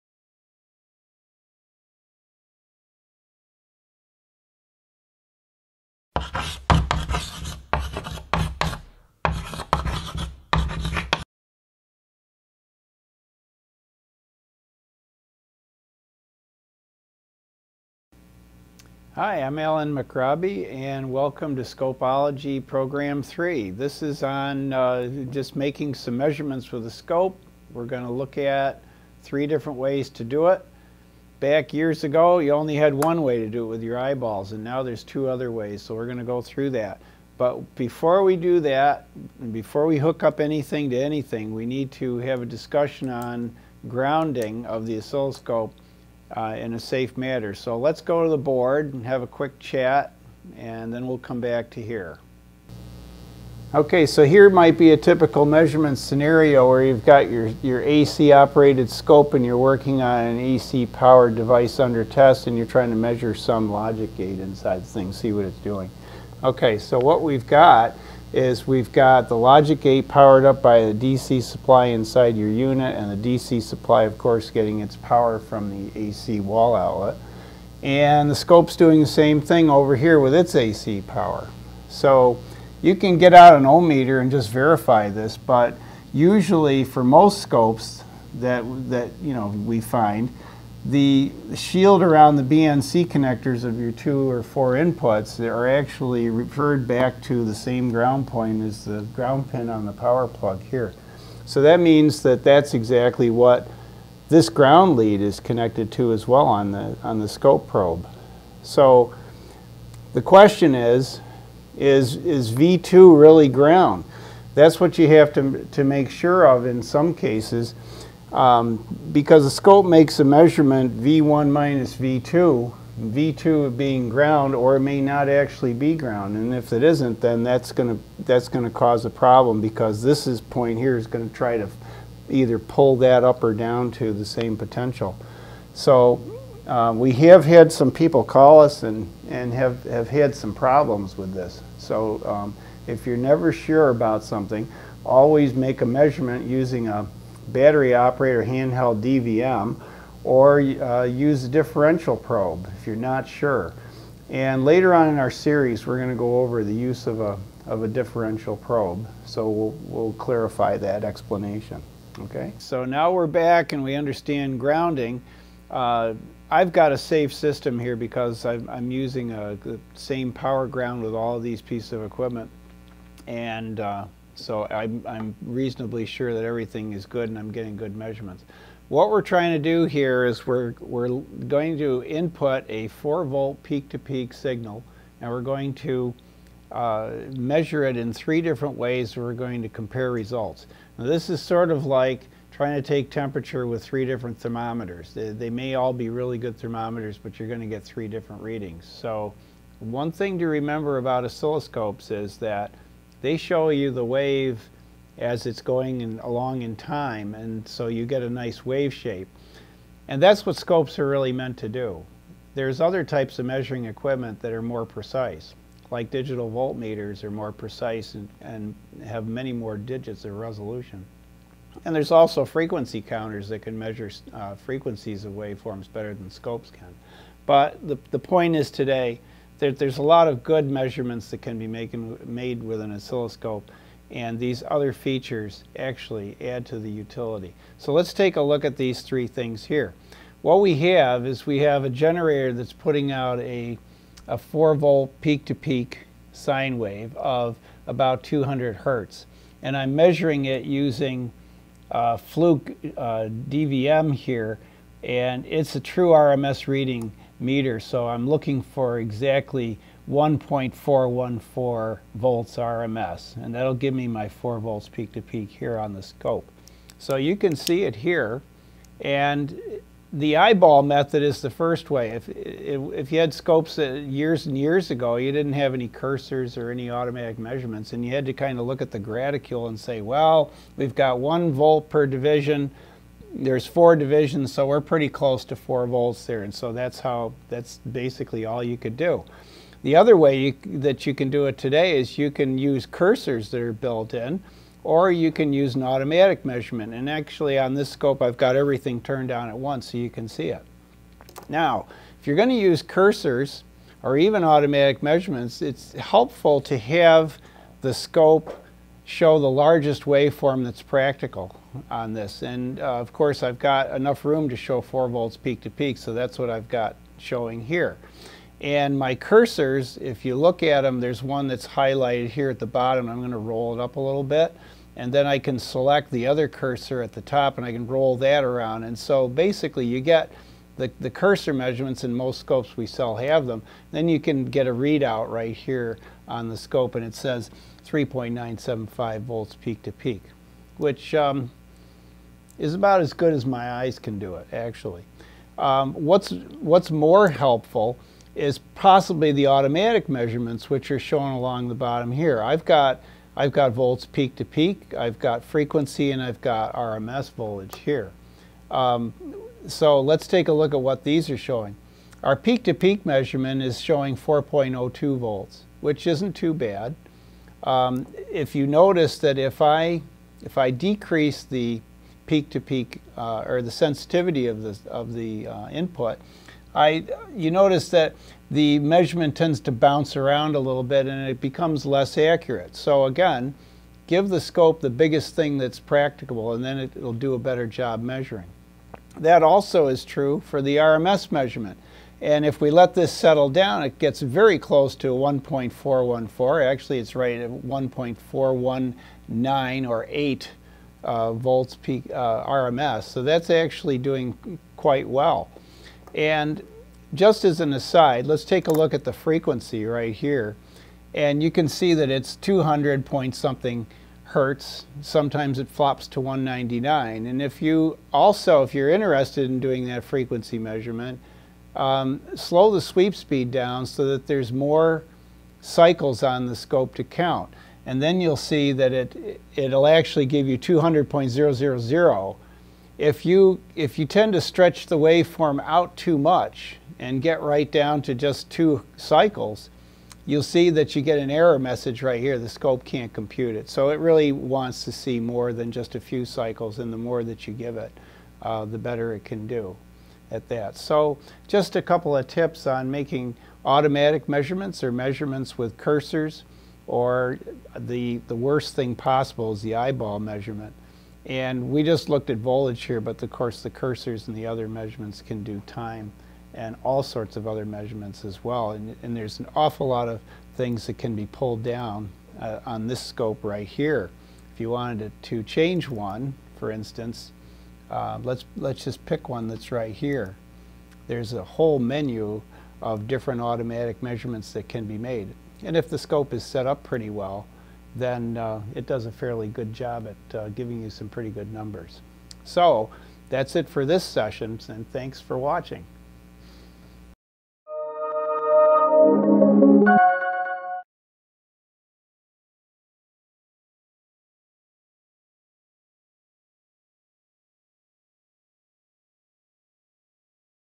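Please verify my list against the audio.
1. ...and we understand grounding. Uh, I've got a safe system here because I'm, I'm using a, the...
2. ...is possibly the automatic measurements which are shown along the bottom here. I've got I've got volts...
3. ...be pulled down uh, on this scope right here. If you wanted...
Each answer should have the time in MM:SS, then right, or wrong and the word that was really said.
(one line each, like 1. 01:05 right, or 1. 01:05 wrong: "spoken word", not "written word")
1. 02:43 right
2. 05:48 right
3. 07:51 right.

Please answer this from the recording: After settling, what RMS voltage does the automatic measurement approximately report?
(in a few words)
1.419 volts.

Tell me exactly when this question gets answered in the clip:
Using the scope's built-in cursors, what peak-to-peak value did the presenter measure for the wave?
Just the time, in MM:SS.
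05:37.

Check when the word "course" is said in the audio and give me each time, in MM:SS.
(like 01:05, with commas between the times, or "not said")
01:14, 05:13, 07:43.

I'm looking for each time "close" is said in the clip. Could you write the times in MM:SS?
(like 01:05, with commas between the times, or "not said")
04:45, 06:34.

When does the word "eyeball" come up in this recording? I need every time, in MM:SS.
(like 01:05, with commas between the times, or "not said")
00:33, 04:30, 07:39.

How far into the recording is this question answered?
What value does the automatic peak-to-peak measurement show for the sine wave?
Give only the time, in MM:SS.
06:04.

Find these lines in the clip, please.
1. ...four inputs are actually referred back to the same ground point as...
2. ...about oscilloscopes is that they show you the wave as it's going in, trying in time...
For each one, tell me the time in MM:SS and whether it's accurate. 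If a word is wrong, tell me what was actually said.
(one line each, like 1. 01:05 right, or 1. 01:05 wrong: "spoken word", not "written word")
1. 01:34 right
2. 03:20 wrong: "along", not "trying".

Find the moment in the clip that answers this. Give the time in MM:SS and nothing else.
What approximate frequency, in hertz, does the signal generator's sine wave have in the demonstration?
04:07.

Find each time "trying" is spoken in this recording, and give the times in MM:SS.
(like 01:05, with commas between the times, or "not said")
01:02, 02:59, 03:12.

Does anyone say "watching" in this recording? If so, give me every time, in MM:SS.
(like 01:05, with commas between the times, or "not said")
08:15.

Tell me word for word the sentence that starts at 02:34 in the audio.
And later on in our series, we're going to go over the use of a, of a differential probe.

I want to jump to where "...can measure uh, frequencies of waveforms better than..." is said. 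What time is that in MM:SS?
03:43.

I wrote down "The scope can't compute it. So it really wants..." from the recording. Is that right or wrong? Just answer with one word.
right.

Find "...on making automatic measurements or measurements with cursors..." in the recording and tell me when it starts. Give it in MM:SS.
07:32.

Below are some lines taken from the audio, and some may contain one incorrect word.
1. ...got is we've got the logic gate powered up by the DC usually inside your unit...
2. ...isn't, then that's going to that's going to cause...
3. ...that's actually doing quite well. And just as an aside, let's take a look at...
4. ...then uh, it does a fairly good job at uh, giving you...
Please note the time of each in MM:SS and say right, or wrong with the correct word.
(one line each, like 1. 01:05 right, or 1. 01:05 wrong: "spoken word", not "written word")
1. 01:07 wrong: "supply", not "usually"
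2. 02:06 right
3. 06:43 right
4. 08:07 right.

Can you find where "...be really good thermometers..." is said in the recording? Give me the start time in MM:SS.
03:15.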